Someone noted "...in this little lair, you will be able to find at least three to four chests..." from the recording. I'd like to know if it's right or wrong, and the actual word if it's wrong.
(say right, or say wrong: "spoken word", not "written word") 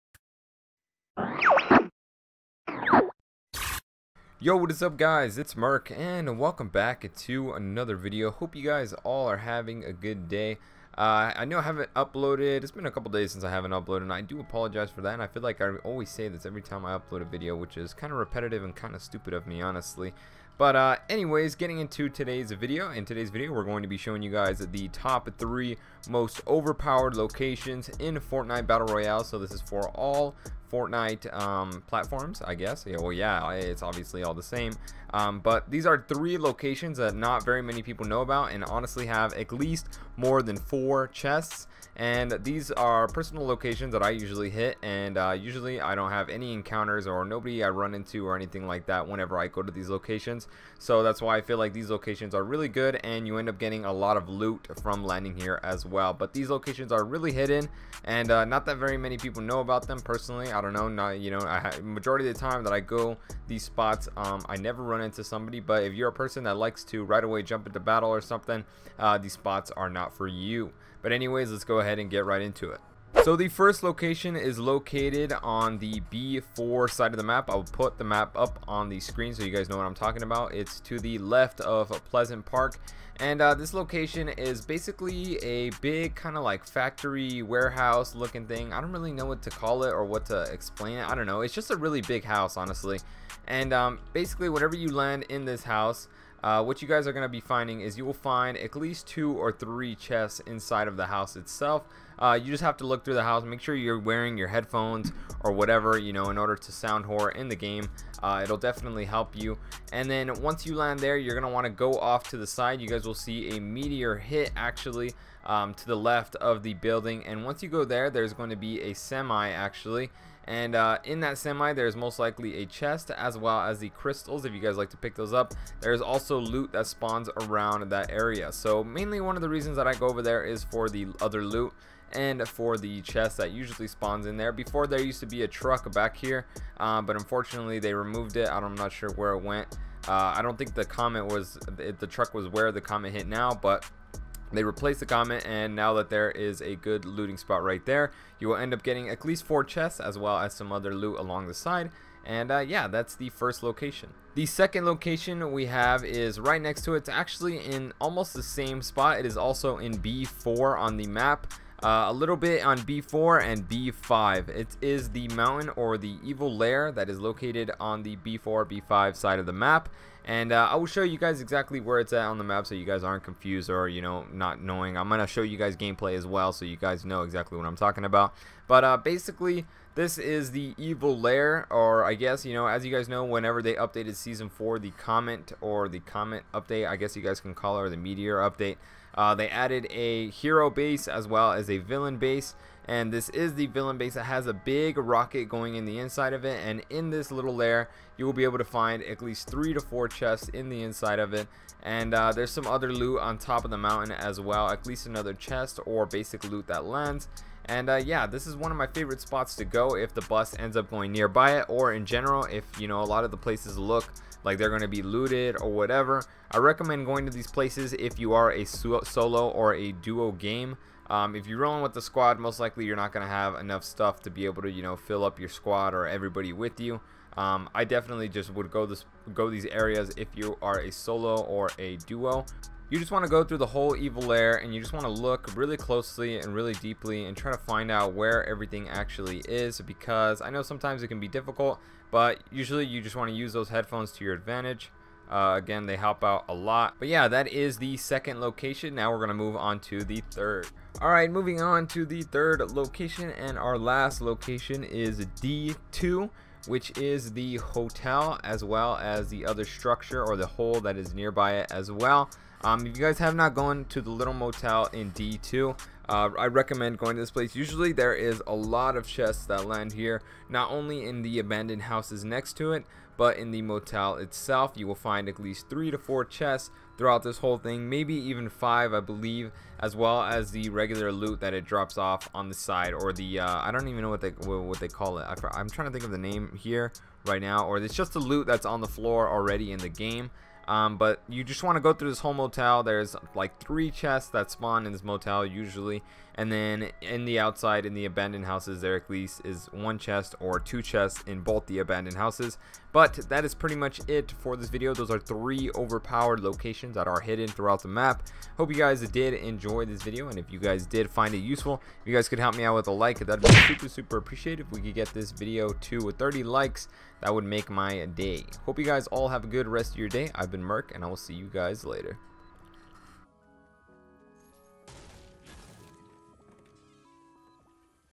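right.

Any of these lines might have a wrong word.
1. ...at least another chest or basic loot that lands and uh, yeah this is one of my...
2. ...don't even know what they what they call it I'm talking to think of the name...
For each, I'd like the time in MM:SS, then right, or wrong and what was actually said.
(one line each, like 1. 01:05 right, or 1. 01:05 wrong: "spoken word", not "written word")
1. 03:24 right
2. 04:43 wrong: "trying", not "talking".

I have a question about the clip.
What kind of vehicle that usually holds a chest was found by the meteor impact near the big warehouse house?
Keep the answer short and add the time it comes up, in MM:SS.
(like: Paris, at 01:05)
A semi, at 01:58.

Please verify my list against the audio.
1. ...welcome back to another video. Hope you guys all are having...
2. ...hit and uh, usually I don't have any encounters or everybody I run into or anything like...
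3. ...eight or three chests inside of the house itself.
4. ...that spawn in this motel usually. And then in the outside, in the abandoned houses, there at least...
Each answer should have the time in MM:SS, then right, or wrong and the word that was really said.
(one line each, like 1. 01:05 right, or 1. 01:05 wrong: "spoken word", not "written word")
1. 00:06 right
2. 00:44 wrong: "nobody", not "everybody"
3. 01:39 wrong: "two", not "eight"
4. 04:54 right.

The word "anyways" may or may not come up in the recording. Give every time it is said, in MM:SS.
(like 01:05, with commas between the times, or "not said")
00:21, 01:11.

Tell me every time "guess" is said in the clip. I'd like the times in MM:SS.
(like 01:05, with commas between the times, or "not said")
00:32, 03:02, 03:06.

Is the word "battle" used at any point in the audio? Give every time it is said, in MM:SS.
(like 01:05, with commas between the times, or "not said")
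00:28, 01:07.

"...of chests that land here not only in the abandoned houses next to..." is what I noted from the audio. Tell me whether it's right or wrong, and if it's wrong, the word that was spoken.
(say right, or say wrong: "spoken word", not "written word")
right.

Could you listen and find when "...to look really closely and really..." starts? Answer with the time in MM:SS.
03:55.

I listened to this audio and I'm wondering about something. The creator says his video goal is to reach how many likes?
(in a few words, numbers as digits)
30.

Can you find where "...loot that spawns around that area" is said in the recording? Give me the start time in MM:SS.
02:06.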